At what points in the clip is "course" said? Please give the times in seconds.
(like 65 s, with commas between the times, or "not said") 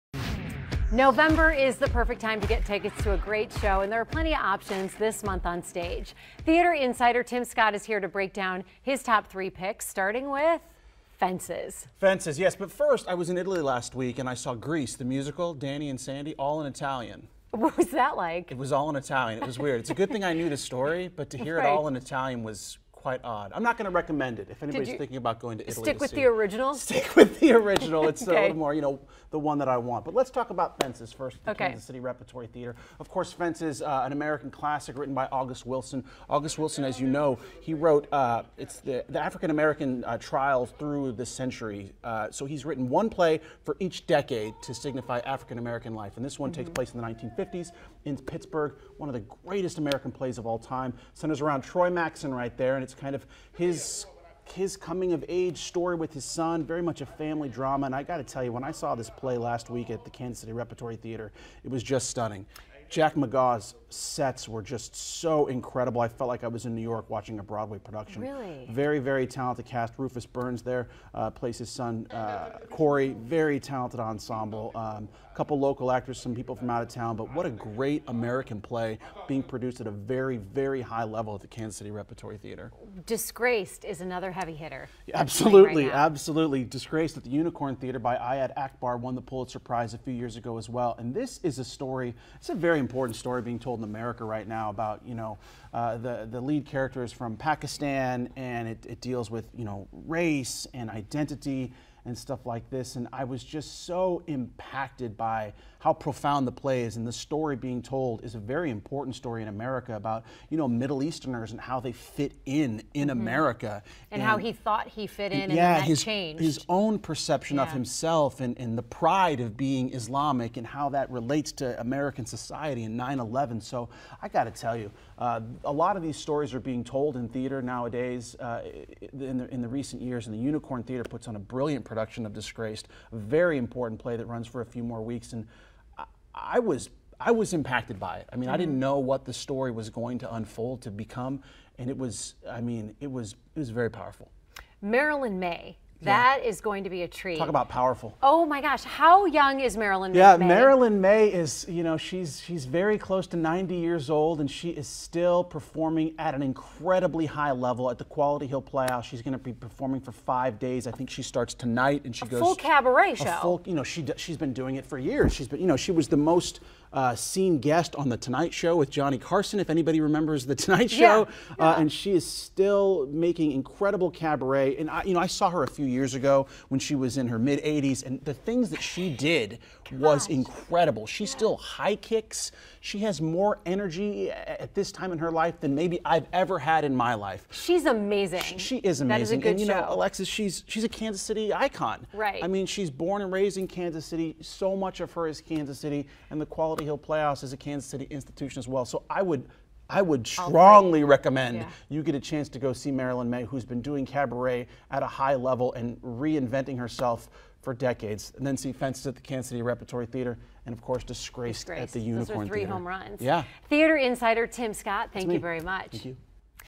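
33 s, 210 s.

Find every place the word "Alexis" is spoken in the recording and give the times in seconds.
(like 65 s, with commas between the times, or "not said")
189 s.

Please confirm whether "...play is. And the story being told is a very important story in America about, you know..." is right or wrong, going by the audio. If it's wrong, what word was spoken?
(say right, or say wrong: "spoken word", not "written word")
right.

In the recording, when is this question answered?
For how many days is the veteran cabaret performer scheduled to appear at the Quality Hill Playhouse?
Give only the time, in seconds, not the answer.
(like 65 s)
160 s.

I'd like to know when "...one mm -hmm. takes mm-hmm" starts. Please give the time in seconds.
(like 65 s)
46 s.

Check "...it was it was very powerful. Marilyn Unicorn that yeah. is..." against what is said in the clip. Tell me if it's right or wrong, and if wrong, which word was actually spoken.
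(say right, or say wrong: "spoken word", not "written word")
wrong: "Maye", not "Unicorn".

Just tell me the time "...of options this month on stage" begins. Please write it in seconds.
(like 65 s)
4 s.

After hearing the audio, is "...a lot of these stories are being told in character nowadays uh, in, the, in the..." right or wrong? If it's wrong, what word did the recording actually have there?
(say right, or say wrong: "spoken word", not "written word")
wrong: "theater", not "character".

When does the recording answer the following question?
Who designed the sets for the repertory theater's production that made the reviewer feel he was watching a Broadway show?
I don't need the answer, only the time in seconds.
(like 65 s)
62 s.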